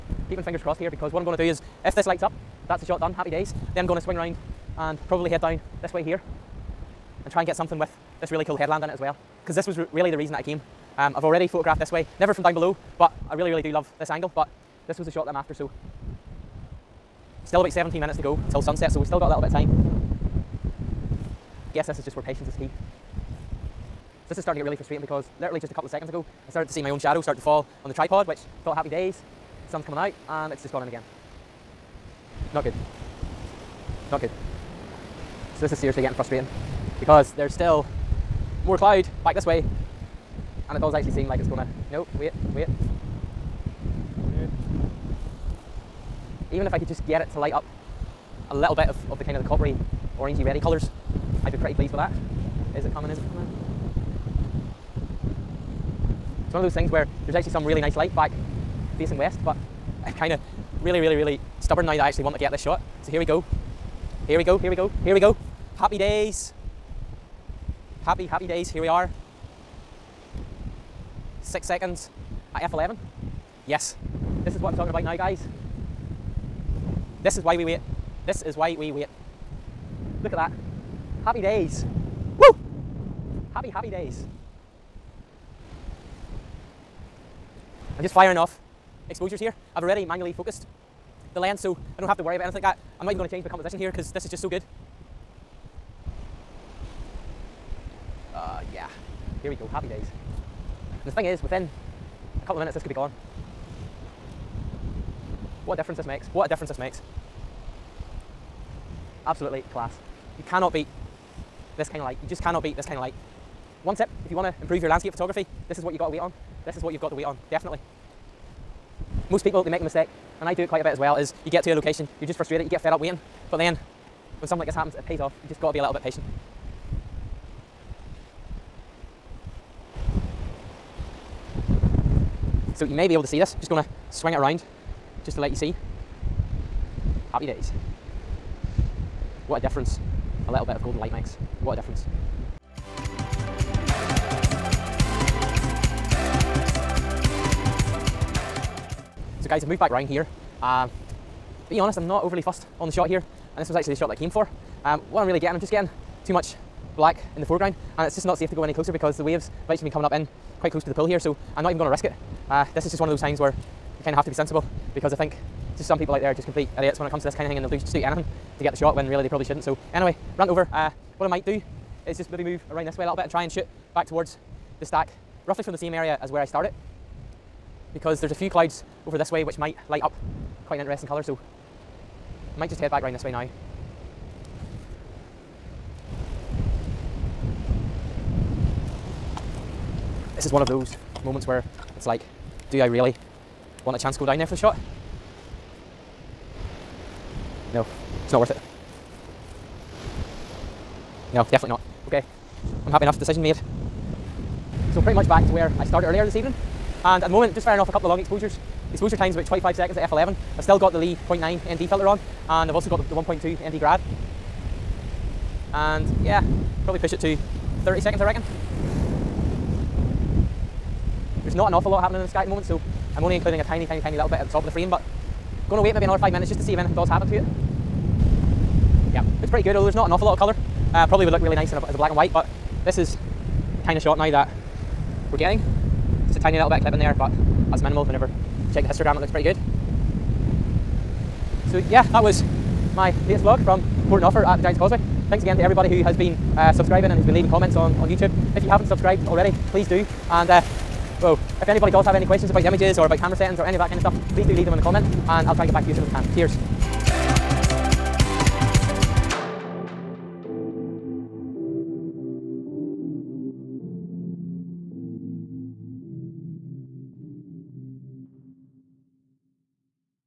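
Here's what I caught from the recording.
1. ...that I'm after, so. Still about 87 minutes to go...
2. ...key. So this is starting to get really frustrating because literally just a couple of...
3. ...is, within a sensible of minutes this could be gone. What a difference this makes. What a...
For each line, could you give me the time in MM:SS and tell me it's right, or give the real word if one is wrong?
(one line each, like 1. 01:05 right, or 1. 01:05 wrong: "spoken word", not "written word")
1. 00:15 wrong: "17", not "87"
2. 00:22 right
3. 01:41 wrong: "couple", not "sensible".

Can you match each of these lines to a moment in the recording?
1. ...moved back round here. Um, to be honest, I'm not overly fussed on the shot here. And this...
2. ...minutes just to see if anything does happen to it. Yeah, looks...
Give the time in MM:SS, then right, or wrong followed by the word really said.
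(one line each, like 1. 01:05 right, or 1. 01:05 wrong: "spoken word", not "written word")
1. 02:29 right
2. 03:46 right.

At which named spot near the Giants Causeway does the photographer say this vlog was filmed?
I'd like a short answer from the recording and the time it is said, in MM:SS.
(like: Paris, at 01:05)
Port Noffer, at 04:04.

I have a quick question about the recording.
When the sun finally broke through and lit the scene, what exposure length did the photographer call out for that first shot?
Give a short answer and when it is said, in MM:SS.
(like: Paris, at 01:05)
6 seconds, at 01:11.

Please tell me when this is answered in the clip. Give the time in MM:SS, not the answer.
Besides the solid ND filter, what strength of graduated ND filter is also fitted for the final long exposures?
03:33.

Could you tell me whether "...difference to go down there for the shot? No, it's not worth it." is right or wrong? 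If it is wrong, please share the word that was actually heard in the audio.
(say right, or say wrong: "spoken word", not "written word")
wrong: "chance", not "difference".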